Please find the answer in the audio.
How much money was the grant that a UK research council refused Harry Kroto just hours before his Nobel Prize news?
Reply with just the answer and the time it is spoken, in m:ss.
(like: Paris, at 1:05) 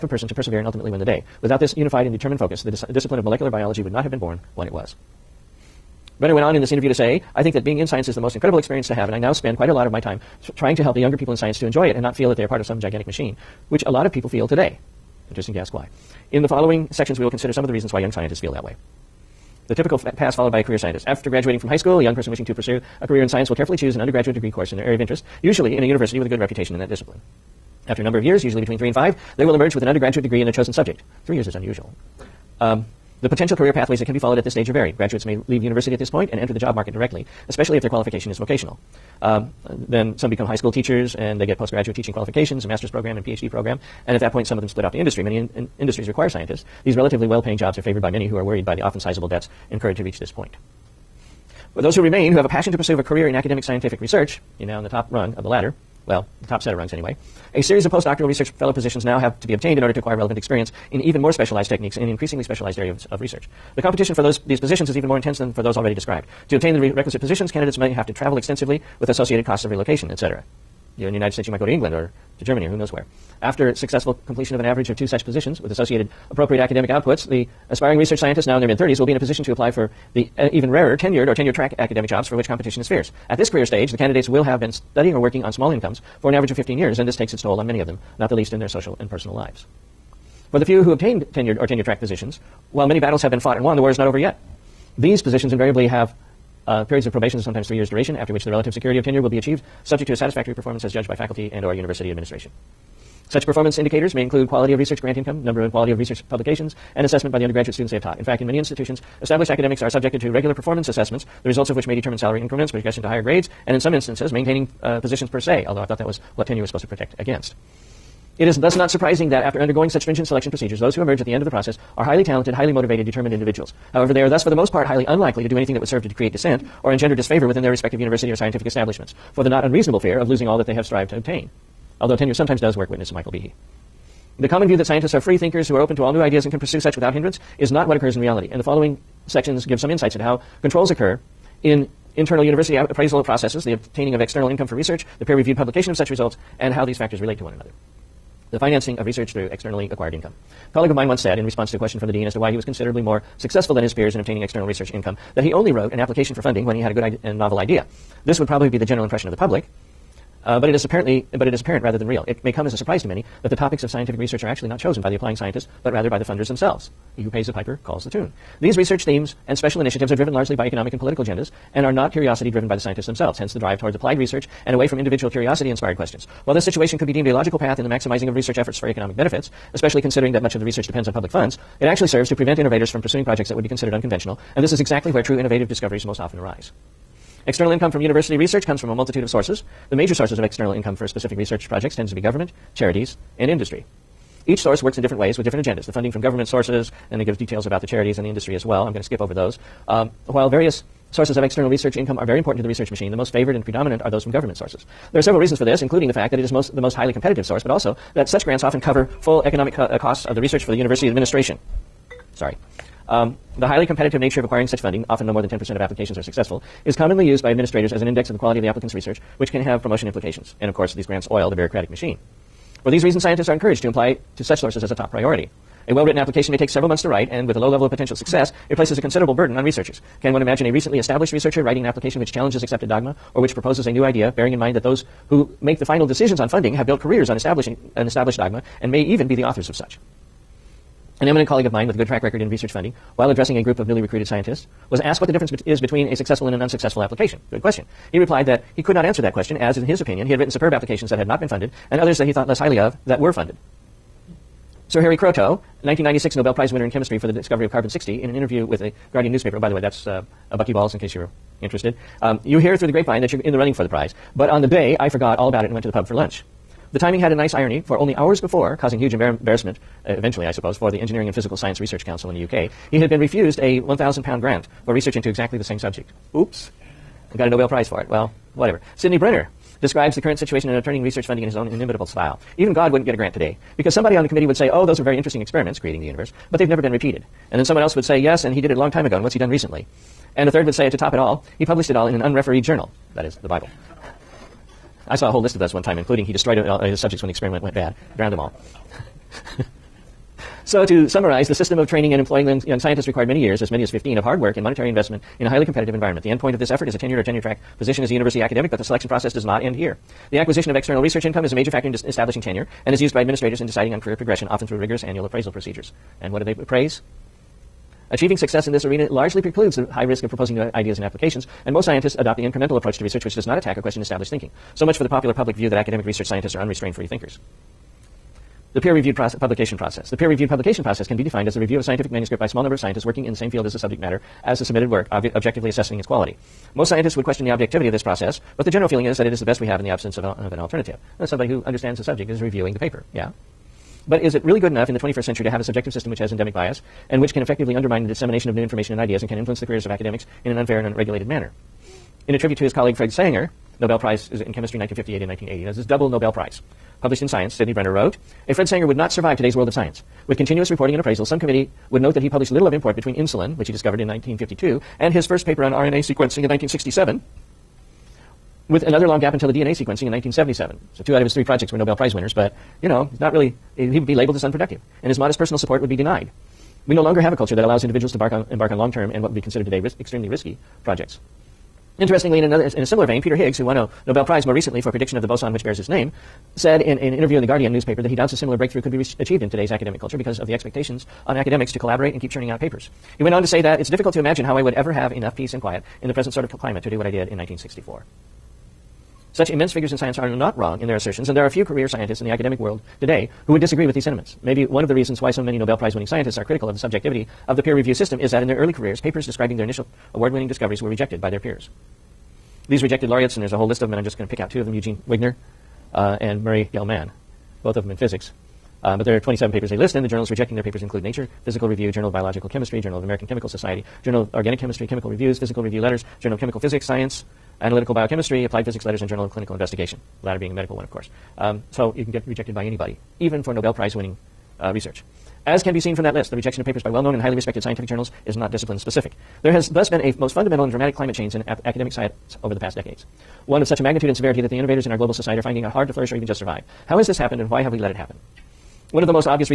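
1,000 pounds, at 4:33.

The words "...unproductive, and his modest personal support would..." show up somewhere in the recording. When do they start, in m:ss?
6:14.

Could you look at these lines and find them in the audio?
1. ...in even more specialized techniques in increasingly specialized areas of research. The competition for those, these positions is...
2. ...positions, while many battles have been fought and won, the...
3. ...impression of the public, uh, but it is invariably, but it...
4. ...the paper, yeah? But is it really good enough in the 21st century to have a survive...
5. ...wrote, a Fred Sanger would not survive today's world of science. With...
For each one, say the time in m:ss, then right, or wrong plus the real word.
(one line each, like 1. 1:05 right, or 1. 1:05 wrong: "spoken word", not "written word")
1. 1:00 right
2. 1:32 right
3. 2:39 wrong: "apparently", not "invariably"
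4. 5:42 wrong: "subjective", not "survive"
5. 5:57 right.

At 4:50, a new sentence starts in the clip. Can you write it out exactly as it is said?
And a third would say, to top it all, he published it all in an unrefereed journal, that is, the Bible.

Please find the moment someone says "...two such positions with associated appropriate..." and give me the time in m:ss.
1:14.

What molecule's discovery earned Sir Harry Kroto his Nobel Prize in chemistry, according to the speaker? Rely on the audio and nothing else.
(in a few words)
carbon 60.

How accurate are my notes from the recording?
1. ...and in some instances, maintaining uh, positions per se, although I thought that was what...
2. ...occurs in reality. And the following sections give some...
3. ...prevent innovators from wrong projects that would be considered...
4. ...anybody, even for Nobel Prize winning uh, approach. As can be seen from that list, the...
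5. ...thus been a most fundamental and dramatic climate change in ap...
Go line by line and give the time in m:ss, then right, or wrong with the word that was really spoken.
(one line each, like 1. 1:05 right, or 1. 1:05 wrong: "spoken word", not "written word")
1. 1:53 right
2. 2:17 right
3. 3:02 wrong: "pursuing", not "wrong"
4. 7:12 wrong: "research", not "approach"
5. 7:19 right.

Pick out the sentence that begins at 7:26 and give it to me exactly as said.
How has this happened and why have we let it happen?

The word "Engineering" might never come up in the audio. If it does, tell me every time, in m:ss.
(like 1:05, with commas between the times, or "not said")
4:31.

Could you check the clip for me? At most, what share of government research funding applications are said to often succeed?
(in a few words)
10%.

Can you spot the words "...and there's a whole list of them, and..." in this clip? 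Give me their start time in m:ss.
6:53.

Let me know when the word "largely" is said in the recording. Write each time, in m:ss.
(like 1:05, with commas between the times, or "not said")
2:50, 5:19.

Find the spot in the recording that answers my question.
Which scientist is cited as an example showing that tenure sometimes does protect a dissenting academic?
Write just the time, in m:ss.
2:13.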